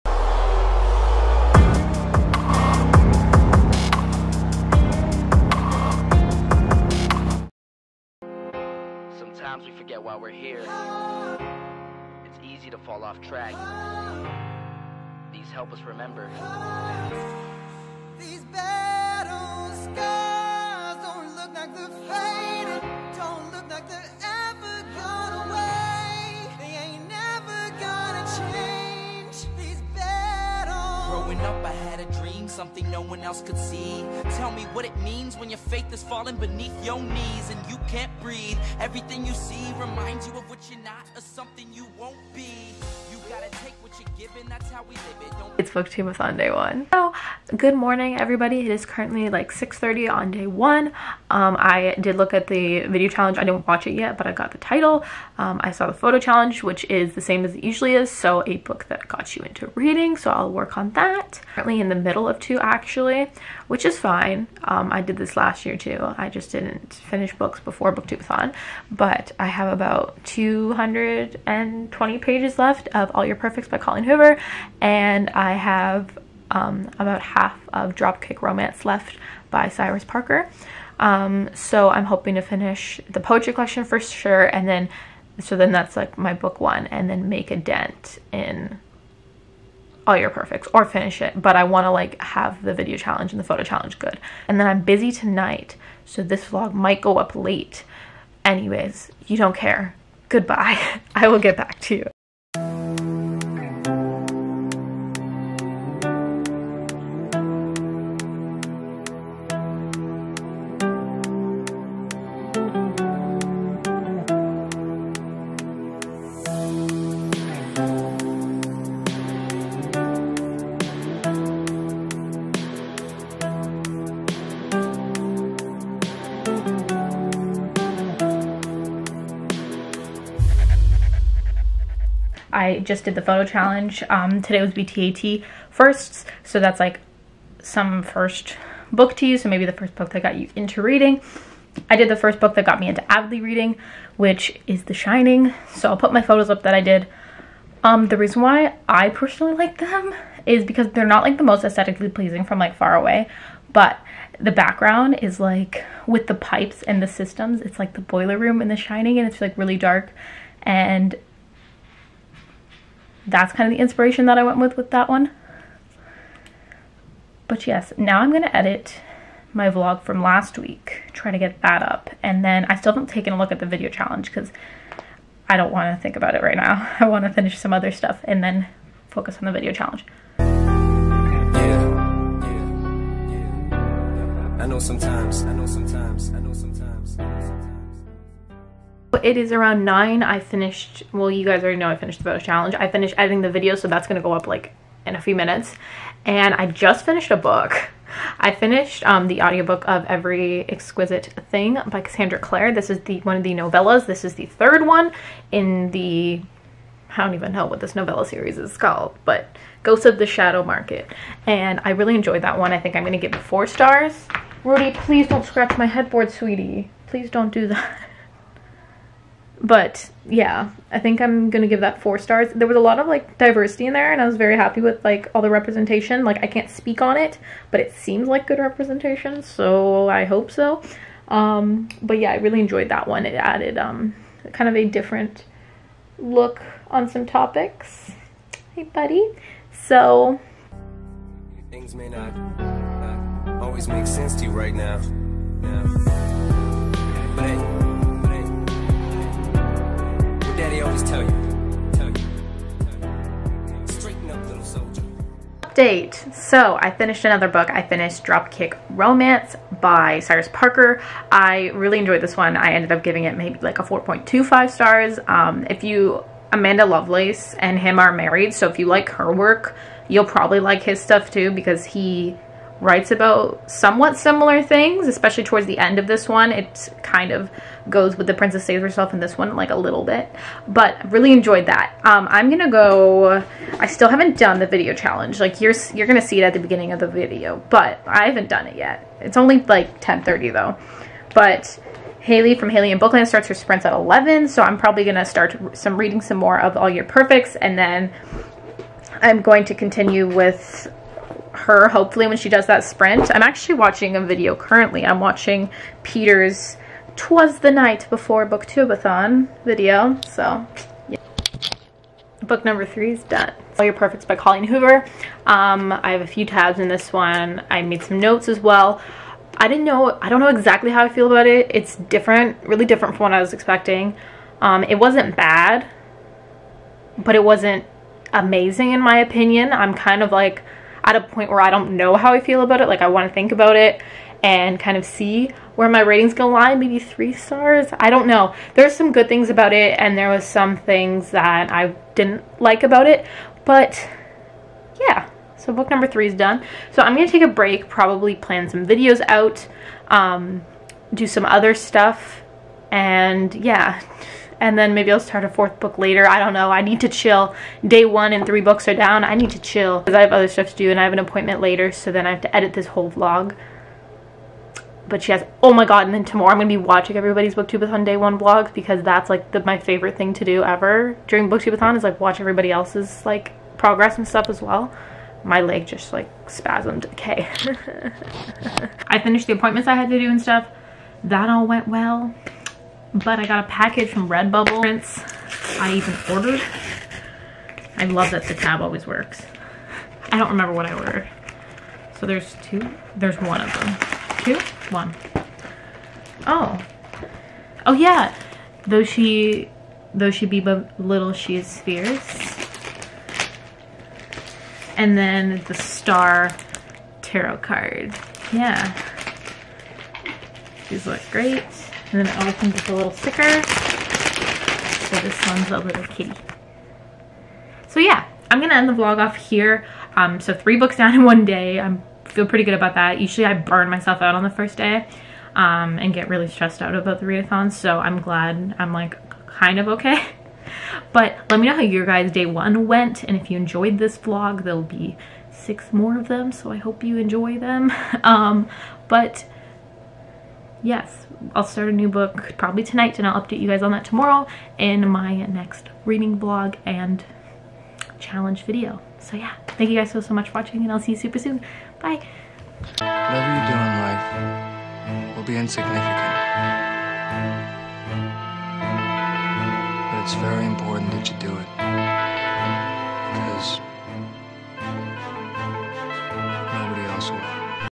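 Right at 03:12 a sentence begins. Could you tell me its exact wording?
I finished editing the video, so that's going to go up like in a few minutes.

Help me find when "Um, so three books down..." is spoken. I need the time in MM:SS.
07:00.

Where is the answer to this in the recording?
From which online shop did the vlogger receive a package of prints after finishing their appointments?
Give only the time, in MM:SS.
06:24.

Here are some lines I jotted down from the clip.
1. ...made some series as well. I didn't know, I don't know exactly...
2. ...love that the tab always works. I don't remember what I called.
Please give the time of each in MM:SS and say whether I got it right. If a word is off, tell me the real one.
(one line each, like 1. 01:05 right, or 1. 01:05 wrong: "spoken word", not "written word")
1. 05:17 wrong: "notes", not "series"
2. 06:28 wrong: "ordered", not "called".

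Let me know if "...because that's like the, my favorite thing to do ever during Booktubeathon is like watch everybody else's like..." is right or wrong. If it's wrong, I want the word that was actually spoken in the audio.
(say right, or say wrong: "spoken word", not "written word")
right.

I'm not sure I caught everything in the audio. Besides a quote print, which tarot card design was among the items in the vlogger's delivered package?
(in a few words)
The star.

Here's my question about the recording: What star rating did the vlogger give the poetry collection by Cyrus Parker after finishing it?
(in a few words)
4.25 stars.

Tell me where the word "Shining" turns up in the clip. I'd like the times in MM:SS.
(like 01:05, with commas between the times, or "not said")
02:24, 02:38.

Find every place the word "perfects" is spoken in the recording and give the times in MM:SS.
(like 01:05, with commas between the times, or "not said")
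01:13, 01:30, 04:57, 05:13.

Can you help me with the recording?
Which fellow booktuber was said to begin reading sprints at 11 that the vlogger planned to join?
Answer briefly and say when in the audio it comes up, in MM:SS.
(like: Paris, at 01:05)
Hailey in Bookland, at 04:52.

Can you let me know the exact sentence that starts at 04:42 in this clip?
Um, I'm gonna go, I still haven't done the video challenge.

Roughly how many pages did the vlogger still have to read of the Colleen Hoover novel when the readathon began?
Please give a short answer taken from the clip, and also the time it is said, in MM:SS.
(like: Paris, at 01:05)
220, at 01:10.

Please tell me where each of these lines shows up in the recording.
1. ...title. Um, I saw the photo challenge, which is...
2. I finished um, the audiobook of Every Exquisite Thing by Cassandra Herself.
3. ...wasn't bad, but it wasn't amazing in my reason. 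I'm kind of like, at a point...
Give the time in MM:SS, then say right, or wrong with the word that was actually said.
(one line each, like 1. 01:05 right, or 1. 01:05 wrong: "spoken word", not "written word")
1. 00:54 right
2. 03:18 wrong: "Clare", not "Herself"
3. 05:24 wrong: "opinion", not "reason".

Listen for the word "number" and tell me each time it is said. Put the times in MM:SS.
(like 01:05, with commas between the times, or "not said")
05:12, 05:45.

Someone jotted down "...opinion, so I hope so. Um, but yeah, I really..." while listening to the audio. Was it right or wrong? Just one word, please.
wrong.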